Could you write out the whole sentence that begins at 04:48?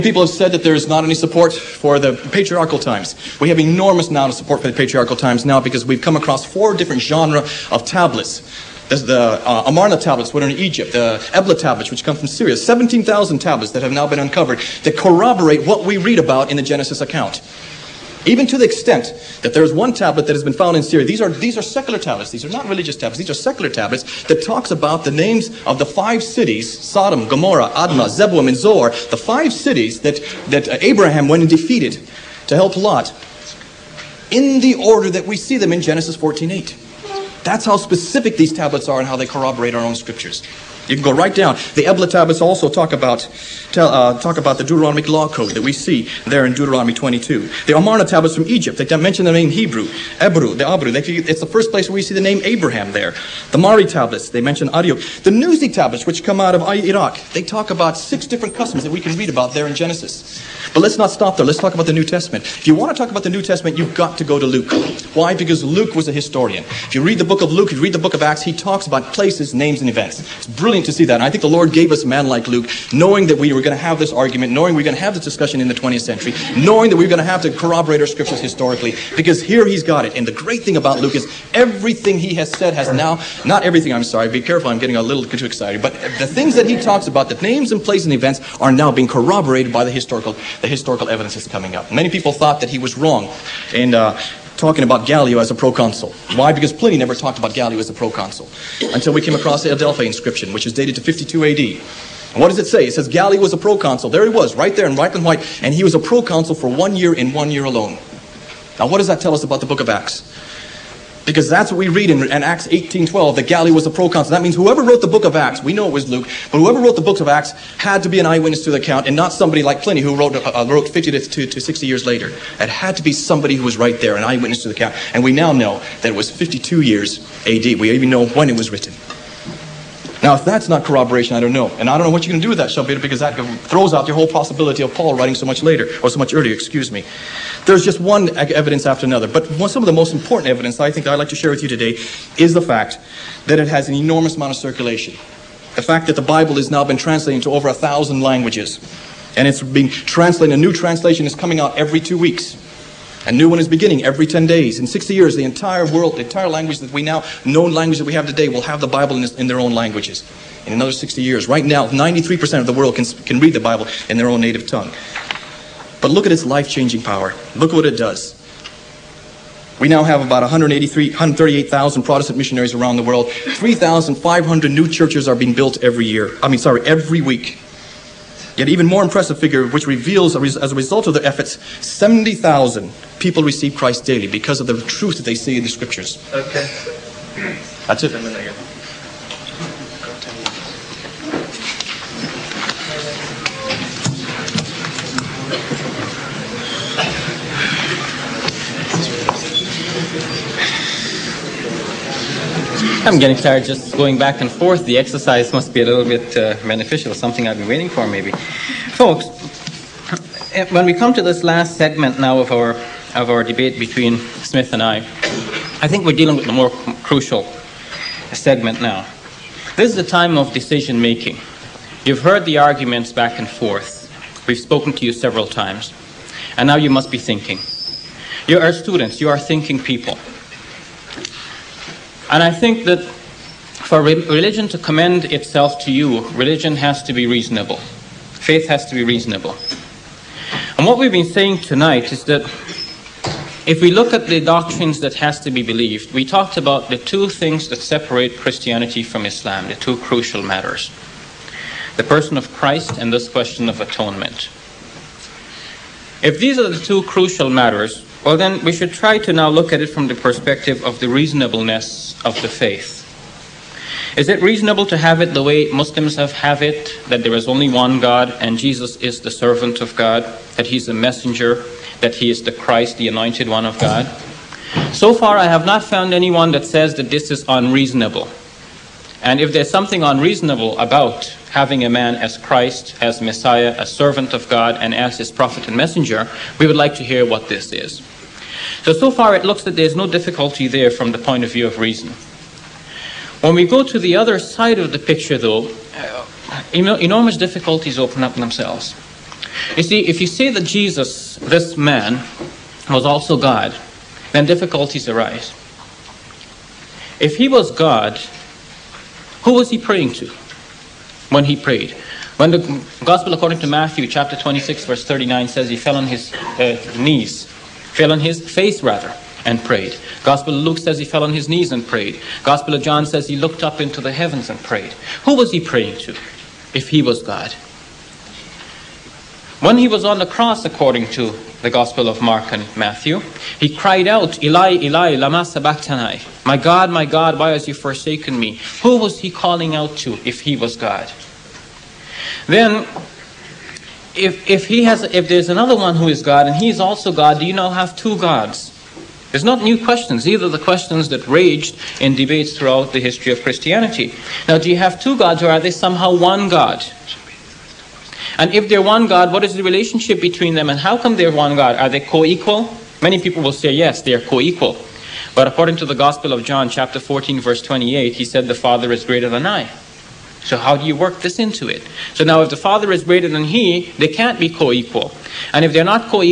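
So, so far it looks that there's no difficulty there from the point of view of reason.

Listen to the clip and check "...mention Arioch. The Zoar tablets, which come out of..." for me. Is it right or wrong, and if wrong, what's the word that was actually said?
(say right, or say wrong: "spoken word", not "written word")
wrong: "Nuzi", not "Zoar".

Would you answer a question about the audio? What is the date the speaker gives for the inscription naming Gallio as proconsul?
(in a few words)
52 AD.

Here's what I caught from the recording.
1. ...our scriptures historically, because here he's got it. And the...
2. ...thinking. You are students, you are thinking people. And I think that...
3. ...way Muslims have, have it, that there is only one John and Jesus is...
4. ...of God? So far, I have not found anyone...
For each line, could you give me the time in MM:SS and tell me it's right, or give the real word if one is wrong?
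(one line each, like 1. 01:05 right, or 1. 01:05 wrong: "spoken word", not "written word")
1. 01:18 right
2. 03:47 right
3. 04:25 wrong: "God", not "John"
4. 04:33 right.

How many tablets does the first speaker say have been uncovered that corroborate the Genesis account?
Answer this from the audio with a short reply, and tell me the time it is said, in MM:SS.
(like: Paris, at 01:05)
17,000, at 00:12.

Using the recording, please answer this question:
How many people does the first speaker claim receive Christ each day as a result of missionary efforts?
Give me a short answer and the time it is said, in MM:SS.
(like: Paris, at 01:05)
70,000, at 03:01.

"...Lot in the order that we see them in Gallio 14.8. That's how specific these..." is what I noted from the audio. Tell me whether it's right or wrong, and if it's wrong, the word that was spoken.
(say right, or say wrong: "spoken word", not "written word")
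wrong: "Genesis", not "Gallio".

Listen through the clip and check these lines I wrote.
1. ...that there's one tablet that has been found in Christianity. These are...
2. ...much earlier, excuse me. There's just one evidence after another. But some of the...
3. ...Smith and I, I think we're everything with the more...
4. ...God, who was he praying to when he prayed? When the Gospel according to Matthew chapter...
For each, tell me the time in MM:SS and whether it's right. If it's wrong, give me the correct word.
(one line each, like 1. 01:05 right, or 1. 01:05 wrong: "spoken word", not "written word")
1. 00:19 wrong: "Syria", not "Christianity"
2. 02:16 right
3. 03:34 wrong: "dealing", not "everything"
4. 05:07 right.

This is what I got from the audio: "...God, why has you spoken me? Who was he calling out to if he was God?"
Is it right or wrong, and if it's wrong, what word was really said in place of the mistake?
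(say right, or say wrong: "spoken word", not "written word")
wrong: "forsaken", not "spoken".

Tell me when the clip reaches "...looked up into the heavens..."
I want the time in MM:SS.
05:23.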